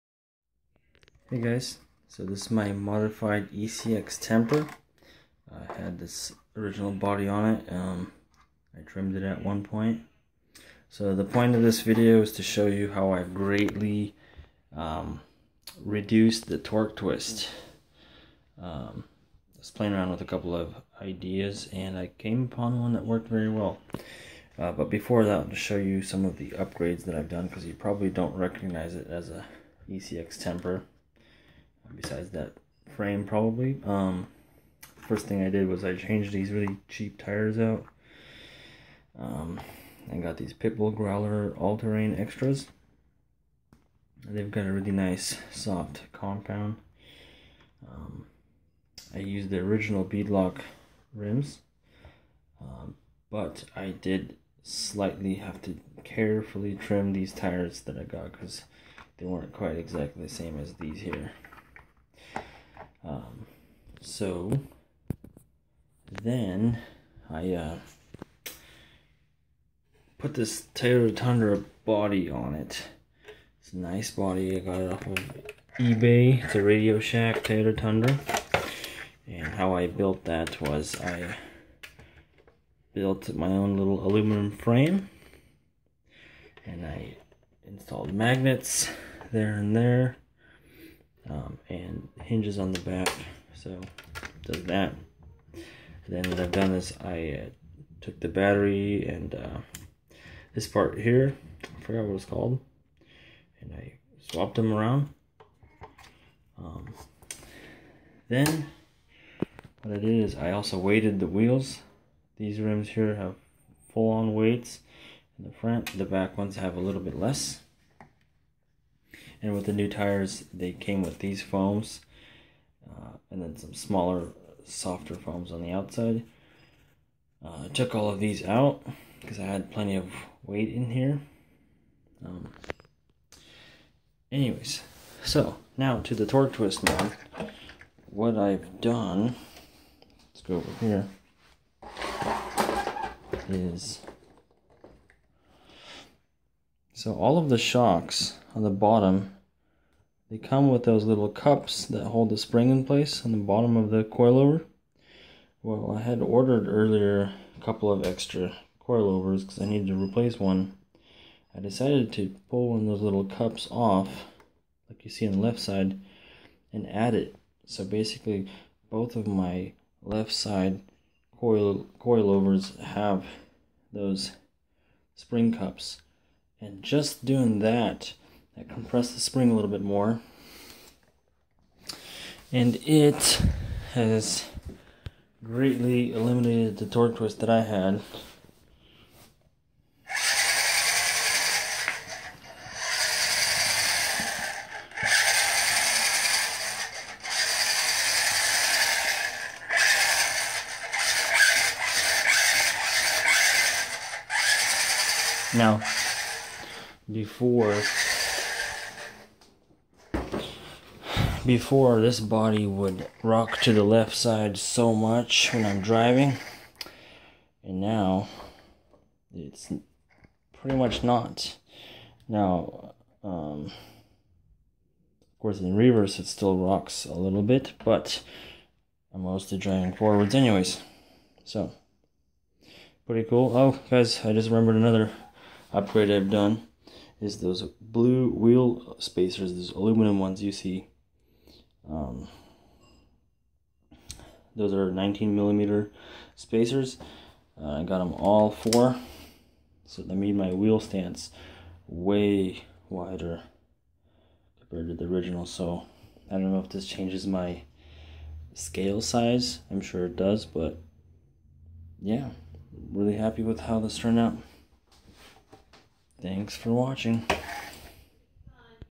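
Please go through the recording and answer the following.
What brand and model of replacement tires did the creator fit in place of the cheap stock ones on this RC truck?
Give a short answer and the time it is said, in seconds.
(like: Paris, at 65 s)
Pitbull Growler, at 40 s.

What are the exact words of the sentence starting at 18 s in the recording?
Um, I was playing around with a couple of ideas and I came upon one that worked very well.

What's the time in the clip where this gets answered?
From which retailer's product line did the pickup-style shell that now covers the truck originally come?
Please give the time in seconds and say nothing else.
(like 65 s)
76 s.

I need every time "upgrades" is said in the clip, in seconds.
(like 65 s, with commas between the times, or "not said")
26 s, 235 s.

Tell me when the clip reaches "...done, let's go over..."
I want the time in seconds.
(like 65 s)
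138 s.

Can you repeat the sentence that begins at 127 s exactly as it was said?
Uh, I took all of these out because I had plenty of weight in here.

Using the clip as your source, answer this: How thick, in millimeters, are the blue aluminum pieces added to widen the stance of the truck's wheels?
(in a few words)
19.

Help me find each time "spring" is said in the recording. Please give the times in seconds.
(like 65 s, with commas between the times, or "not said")
152 s, 175 s, 179 s.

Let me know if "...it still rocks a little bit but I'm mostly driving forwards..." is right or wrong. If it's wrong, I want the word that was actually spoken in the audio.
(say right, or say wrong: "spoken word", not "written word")
right.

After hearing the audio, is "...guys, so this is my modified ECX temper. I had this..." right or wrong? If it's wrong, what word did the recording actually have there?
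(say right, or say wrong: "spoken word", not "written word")
right.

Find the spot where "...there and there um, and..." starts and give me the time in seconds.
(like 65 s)
89 s.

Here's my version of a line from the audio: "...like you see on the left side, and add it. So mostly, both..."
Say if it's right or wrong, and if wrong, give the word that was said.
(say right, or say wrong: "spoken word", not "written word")
wrong: "basically", not "mostly".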